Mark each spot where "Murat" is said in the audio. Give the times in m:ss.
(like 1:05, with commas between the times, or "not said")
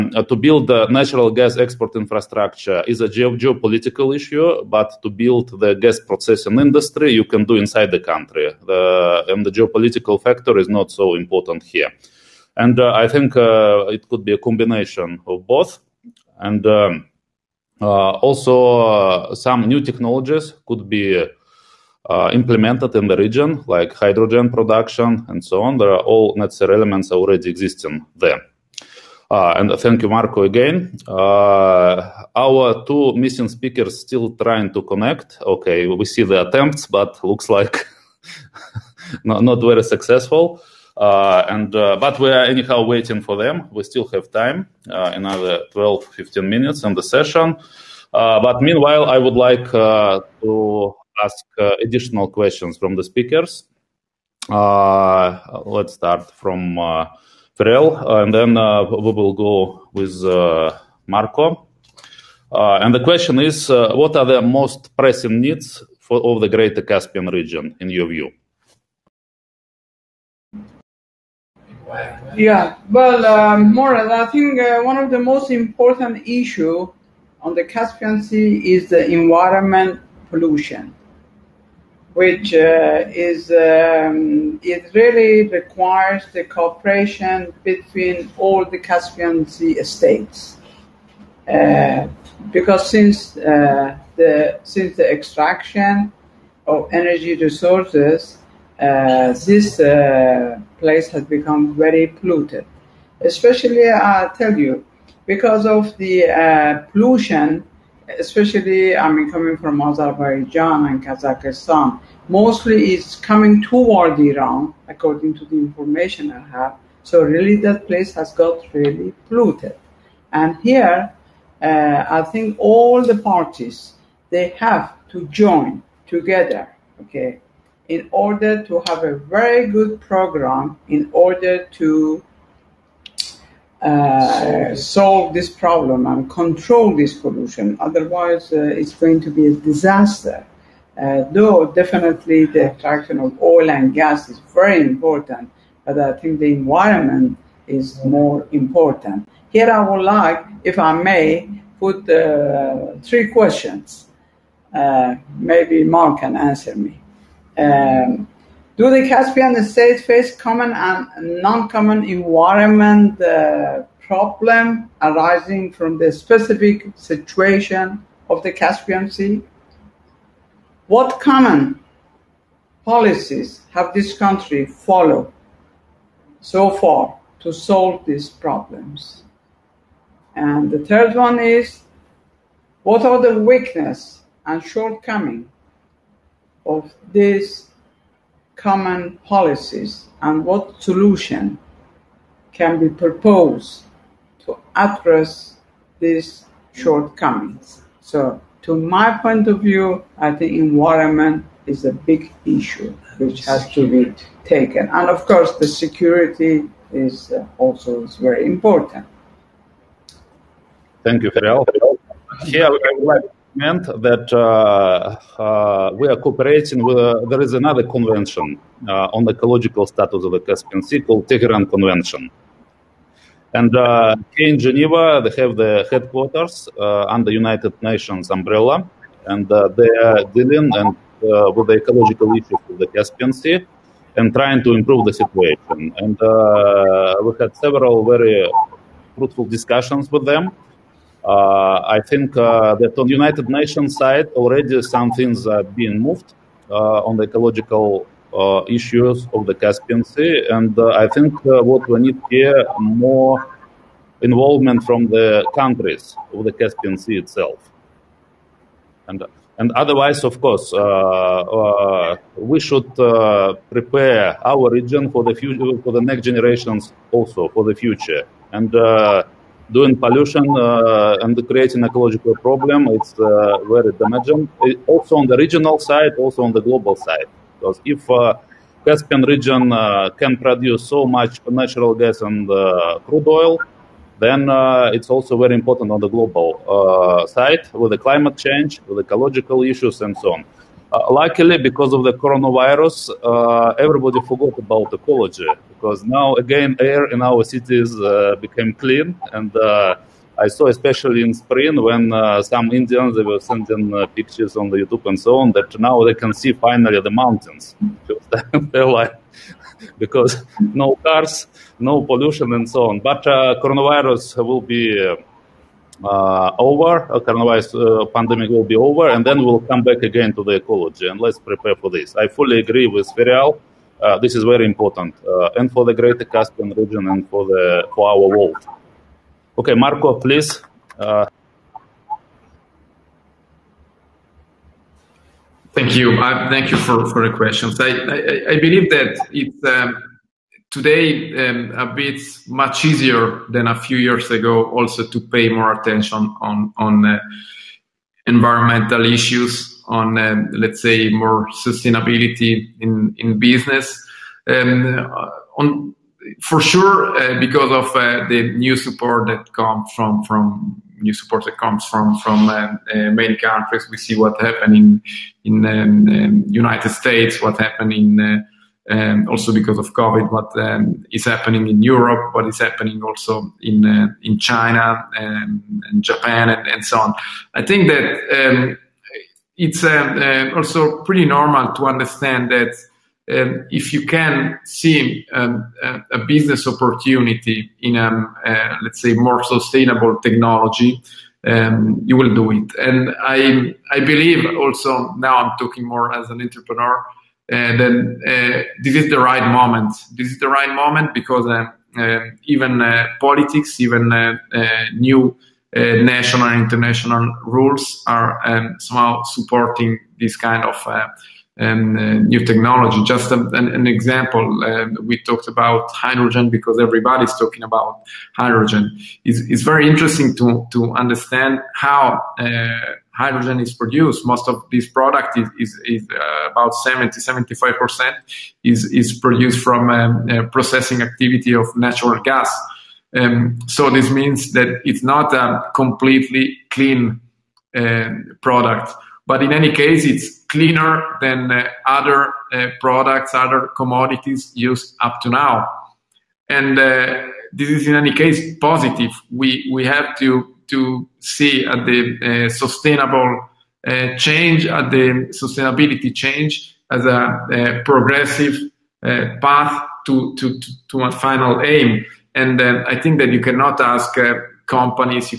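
1:13.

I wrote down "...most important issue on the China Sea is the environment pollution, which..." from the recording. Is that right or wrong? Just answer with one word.
wrong.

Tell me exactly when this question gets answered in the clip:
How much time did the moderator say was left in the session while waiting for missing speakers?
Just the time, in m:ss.
0:45.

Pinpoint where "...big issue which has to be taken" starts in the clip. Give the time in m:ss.
3:21.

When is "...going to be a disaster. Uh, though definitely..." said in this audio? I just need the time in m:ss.
2:18.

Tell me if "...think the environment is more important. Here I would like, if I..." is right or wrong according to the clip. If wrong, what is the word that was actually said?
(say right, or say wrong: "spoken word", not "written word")
right.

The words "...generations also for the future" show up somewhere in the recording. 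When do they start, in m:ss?
4:26.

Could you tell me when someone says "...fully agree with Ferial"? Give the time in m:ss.
5:22.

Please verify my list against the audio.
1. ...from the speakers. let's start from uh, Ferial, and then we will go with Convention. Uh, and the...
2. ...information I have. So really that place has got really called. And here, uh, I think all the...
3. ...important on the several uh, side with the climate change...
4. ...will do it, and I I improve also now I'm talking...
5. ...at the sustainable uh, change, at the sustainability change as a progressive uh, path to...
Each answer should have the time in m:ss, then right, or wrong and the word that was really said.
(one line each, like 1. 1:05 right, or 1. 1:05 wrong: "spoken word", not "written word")
1. 0:52 wrong: "Marco", not "Convention"
2. 1:55 wrong: "polluted", not "called"
3. 4:45 wrong: "global", not "several"
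4. 6:32 wrong: "believe", not "improve"
5. 7:31 right.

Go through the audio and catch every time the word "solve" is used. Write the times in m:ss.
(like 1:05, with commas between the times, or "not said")
2:14, 2:57.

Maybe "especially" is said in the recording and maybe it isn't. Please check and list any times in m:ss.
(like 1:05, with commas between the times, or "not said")
1:43, 1:48, 5:00.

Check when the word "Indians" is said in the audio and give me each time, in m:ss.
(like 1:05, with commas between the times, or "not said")
5:02.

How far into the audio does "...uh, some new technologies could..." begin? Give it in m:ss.
0:19.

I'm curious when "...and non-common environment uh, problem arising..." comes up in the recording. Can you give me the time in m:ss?
2:40.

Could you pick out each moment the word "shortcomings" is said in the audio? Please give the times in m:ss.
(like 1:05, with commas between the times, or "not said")
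3:04, 3:16.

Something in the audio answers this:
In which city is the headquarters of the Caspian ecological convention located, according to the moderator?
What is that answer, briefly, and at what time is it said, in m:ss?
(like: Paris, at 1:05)
Geneva, at 3:44.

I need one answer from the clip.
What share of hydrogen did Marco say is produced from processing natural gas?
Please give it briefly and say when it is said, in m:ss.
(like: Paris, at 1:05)
70-75%, at 7:06.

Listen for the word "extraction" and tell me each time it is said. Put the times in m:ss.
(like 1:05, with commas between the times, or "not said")
1:35.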